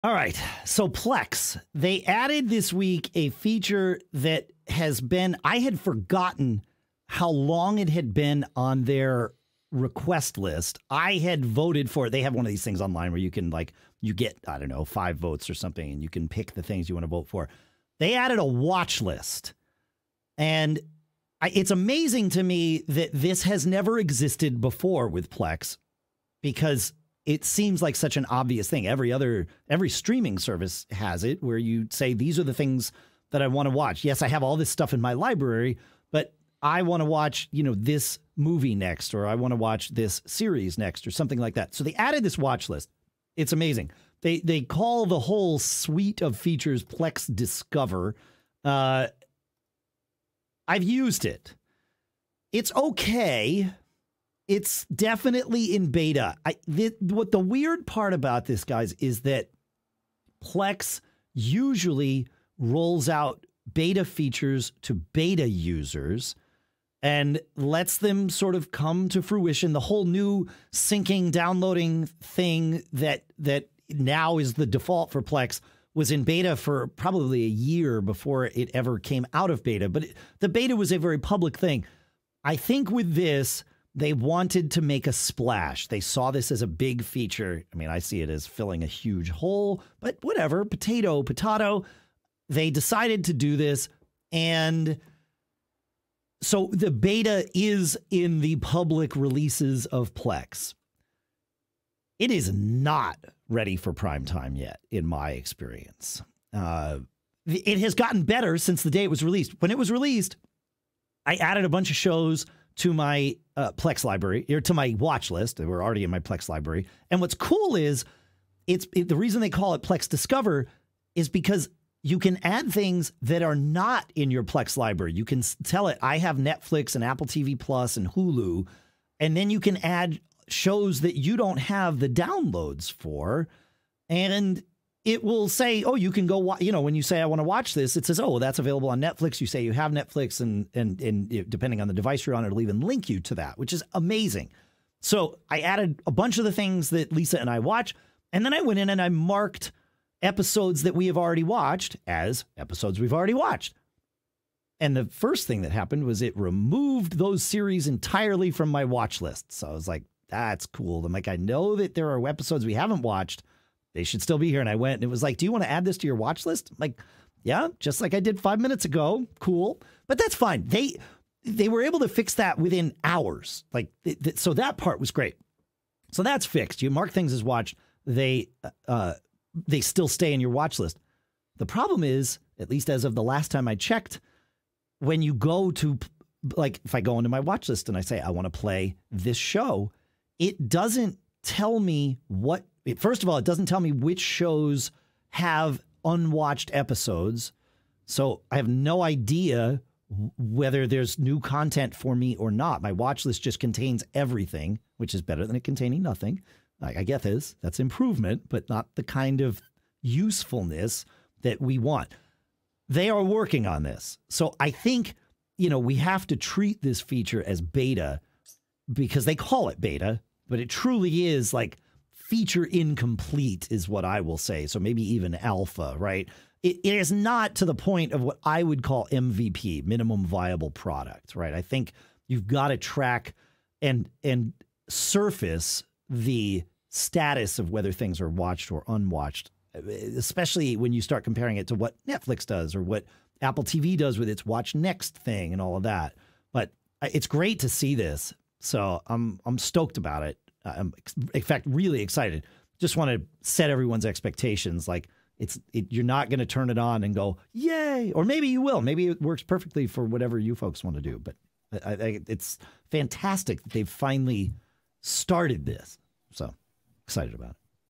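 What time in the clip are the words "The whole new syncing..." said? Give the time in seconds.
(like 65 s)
69 s.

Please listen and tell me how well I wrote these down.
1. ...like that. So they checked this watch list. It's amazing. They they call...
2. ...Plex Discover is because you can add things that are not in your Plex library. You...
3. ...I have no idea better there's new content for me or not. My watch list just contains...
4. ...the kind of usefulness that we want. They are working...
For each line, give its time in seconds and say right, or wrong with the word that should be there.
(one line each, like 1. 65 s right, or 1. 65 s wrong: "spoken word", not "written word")
1. 41 s wrong: "added", not "checked"
2. 119 s right
3. 198 s wrong: "whether", not "better"
4. 208 s right.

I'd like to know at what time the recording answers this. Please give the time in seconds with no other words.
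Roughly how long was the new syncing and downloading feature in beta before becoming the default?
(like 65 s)
77 s.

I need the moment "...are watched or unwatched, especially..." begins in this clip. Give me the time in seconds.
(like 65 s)
238 s.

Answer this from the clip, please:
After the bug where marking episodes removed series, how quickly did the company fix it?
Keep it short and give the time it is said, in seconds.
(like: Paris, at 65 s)
within hours, at 172 s.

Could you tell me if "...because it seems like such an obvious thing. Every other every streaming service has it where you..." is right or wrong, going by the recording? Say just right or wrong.
right.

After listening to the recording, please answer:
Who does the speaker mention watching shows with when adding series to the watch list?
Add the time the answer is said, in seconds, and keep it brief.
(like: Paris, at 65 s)
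Lisa, at 147 s.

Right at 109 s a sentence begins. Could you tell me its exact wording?
When it was released, I added a bunch of shows to my uh, Plex library or to my watch list.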